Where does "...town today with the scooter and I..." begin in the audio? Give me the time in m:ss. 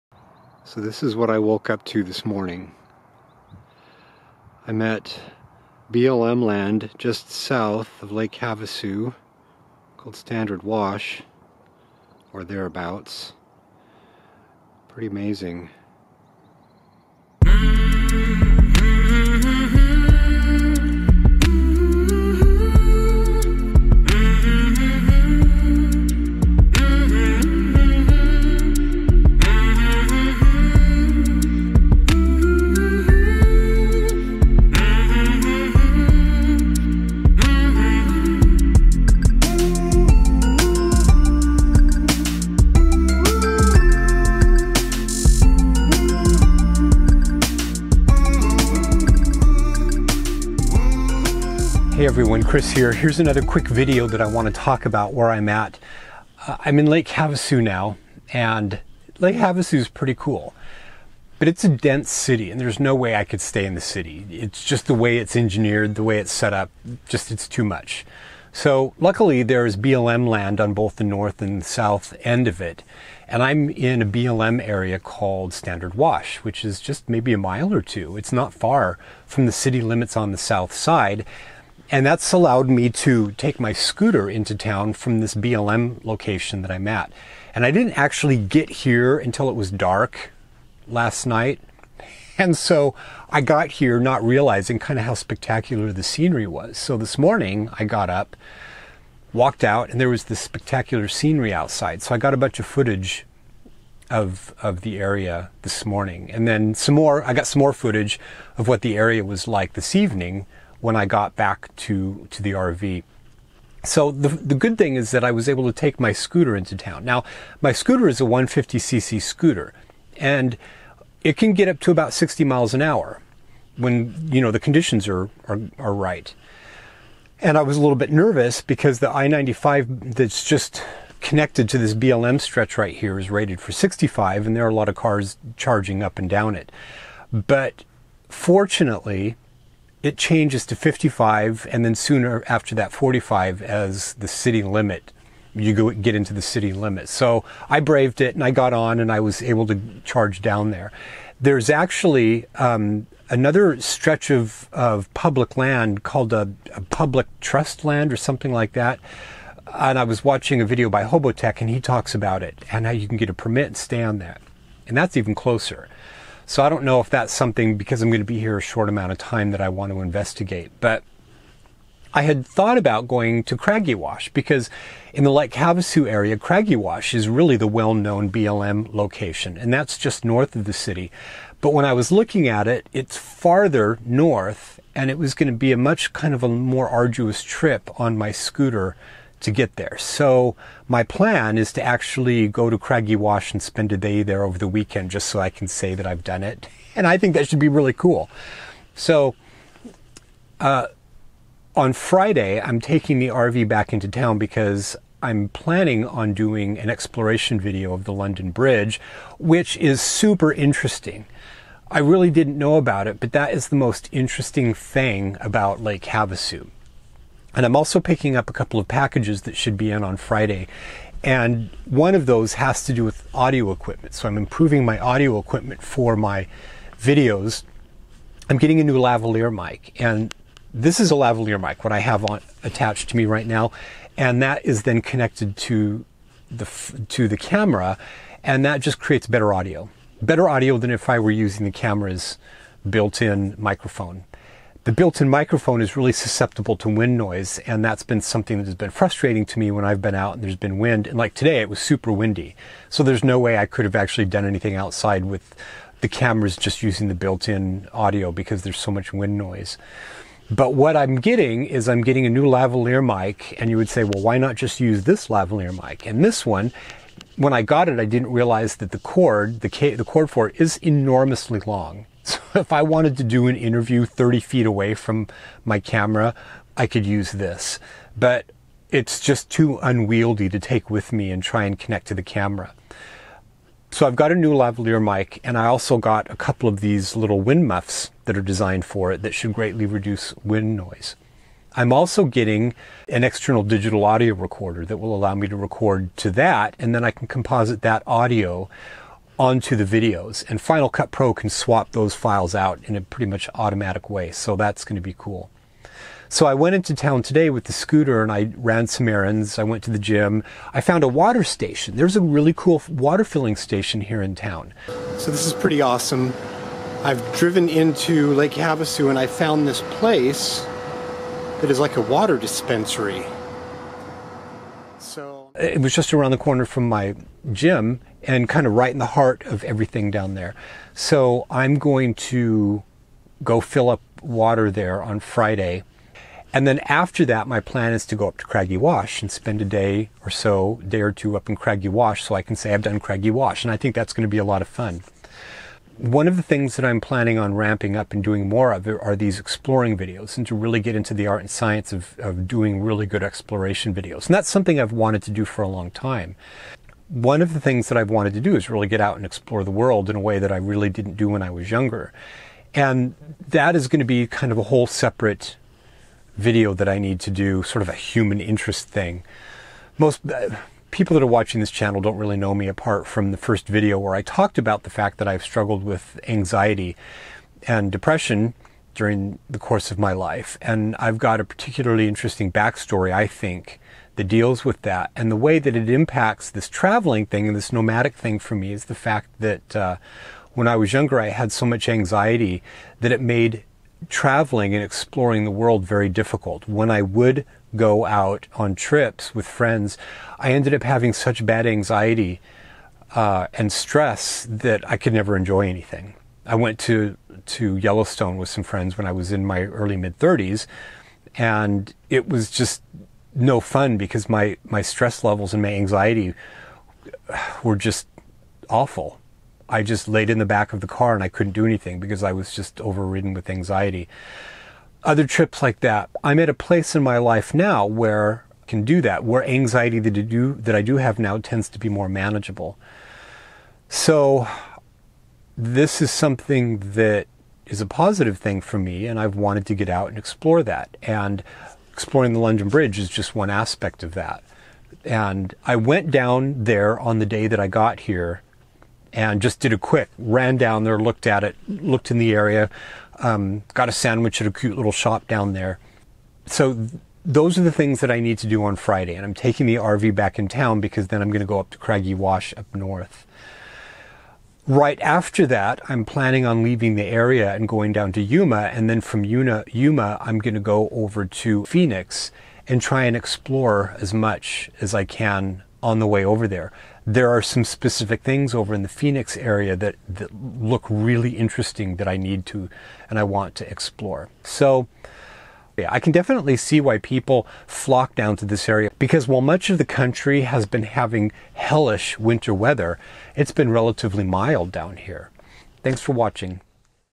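5:06.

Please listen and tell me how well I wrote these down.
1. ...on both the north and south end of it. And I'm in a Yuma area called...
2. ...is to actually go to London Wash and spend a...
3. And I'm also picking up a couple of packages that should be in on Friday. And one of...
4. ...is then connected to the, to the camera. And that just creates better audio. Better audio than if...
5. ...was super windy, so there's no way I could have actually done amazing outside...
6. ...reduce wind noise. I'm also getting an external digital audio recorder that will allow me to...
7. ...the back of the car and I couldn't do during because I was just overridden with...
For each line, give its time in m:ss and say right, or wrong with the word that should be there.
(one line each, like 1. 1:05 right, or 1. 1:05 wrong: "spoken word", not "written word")
1. 1:10 wrong: "BLM", not "Yuma"
2. 3:11 wrong: "Craggy", not "London"
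3. 3:37 right
4. 3:54 right
5. 4:11 wrong: "anything", not "amazing"
6. 4:49 right
7. 7:00 wrong: "anything", not "during".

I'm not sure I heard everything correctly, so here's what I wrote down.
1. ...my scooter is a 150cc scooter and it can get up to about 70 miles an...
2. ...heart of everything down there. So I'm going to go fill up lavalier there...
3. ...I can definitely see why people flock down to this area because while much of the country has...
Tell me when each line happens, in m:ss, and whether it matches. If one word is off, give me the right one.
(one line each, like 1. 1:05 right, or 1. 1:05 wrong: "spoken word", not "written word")
1. 1:57 wrong: "60", not "70"
2. 5:29 wrong: "water", not "lavalier"
3. 8:05 right.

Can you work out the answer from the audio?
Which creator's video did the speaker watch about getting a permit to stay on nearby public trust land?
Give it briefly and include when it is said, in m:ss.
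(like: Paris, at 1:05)
Hobotech, at 2:41.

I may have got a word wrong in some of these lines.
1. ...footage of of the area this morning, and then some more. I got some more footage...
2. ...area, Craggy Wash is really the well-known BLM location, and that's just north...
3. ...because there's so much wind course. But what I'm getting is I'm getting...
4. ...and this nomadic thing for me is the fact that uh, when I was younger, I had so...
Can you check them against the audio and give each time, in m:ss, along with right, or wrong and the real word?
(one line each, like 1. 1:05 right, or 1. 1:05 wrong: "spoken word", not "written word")
1. 1:42 right
2. 2:56 right
3. 4:18 wrong: "noise", not "course"
4. 6:27 right.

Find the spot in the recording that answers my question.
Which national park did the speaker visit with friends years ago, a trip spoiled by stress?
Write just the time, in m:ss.
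6:47.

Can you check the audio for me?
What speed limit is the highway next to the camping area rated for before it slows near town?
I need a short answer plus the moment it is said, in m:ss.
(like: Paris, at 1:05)
65, at 2:13.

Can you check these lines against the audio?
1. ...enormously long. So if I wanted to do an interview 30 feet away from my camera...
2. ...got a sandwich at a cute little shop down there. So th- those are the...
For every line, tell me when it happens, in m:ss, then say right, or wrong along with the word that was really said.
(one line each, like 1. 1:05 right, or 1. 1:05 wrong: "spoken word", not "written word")
1. 4:30 right
2. 7:33 right.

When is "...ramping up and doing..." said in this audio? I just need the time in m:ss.
5:47.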